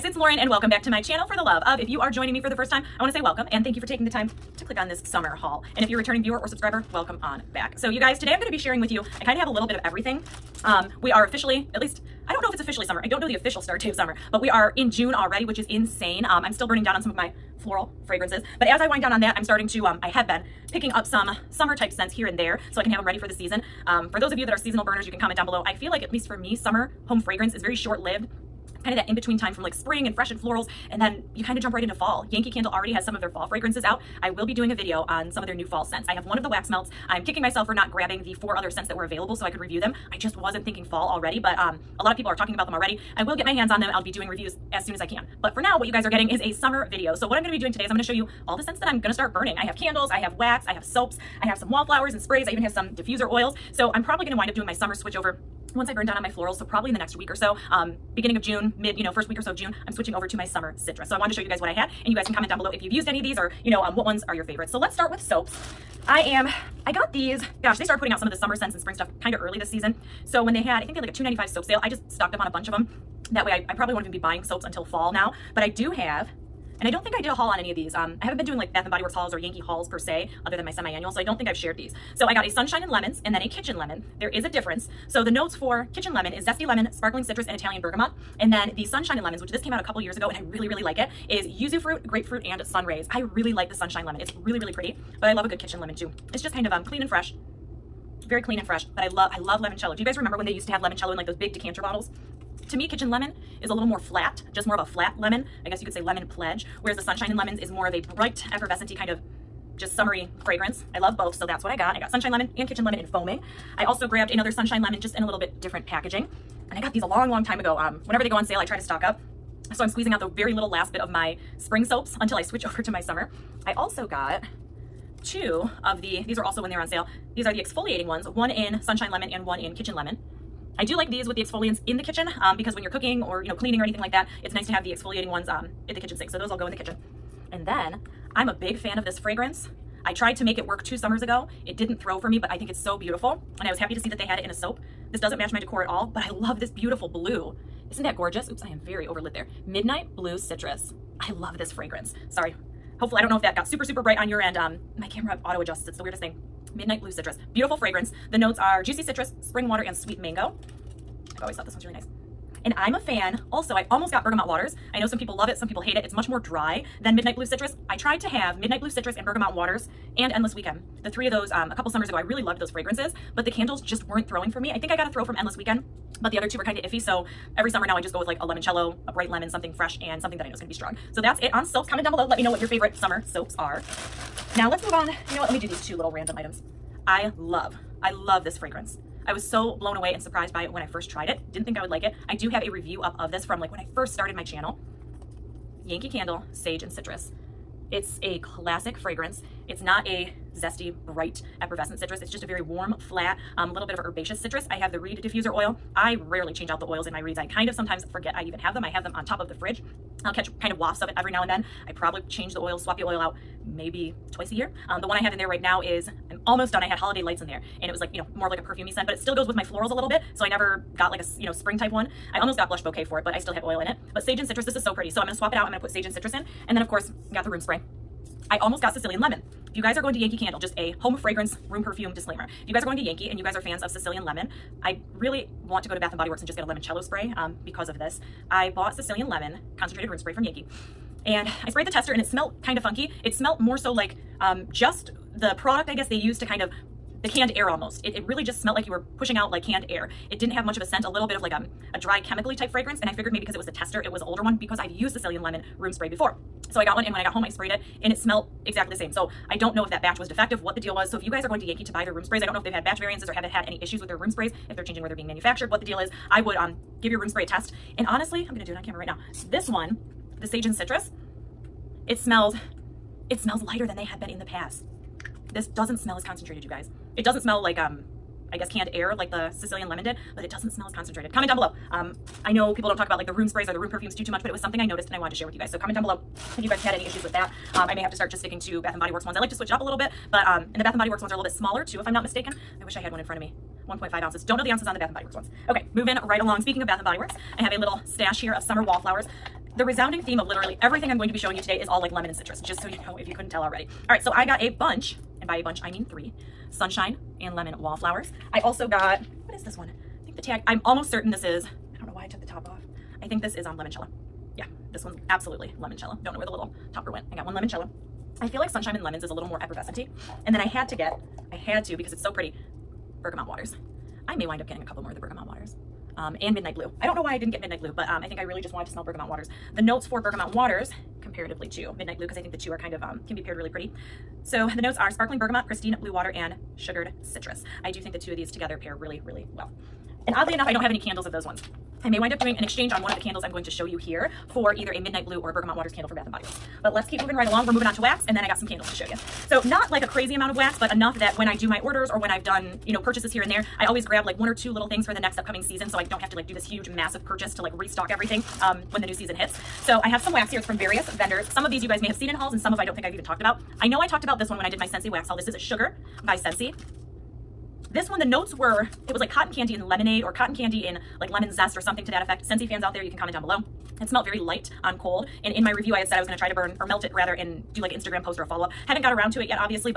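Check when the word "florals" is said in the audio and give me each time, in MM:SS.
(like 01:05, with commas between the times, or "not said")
00:17, 00:30, 00:56, 03:39.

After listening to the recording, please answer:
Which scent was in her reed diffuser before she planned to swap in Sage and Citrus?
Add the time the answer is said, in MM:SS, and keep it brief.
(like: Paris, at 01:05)
Holiday Lights, at 03:36.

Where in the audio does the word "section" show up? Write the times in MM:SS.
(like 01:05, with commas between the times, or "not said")
not said.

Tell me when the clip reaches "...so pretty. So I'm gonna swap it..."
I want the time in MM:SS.
03:44.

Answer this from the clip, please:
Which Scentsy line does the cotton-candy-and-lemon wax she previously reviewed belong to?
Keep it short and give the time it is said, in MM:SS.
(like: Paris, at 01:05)
Sugar, at 06:05.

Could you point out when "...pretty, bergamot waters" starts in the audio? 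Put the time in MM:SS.
05:22.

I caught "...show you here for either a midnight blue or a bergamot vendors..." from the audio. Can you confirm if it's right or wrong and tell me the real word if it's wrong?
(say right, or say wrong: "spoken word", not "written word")
wrong: "waters", not "vendors".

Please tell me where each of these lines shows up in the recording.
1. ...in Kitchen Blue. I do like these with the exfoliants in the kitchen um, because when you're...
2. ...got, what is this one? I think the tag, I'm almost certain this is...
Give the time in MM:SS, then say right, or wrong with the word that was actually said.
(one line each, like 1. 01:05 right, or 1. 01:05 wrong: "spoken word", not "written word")
1. 02:09 wrong: "Lemon", not "Blue"
2. 05:08 right.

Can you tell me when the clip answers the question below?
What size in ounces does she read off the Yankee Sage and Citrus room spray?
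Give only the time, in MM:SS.
04:53.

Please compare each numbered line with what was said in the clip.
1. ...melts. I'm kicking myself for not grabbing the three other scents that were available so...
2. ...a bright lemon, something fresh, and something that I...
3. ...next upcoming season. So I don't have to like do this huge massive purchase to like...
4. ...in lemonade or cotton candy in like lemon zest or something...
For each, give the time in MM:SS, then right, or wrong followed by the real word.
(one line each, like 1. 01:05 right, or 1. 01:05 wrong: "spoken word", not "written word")
1. 00:36 wrong: "four", not "three"
2. 02:59 right
3. 05:55 right
4. 06:09 right.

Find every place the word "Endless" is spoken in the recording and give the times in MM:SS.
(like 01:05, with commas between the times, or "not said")
02:50, 02:55.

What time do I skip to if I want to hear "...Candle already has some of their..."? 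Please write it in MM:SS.
00:32.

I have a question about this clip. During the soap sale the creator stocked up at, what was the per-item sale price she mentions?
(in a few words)
2.95.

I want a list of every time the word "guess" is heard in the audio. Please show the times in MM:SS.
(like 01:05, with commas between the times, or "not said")
01:45, 04:05, 04:38.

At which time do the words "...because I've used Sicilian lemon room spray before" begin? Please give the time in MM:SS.
04:14.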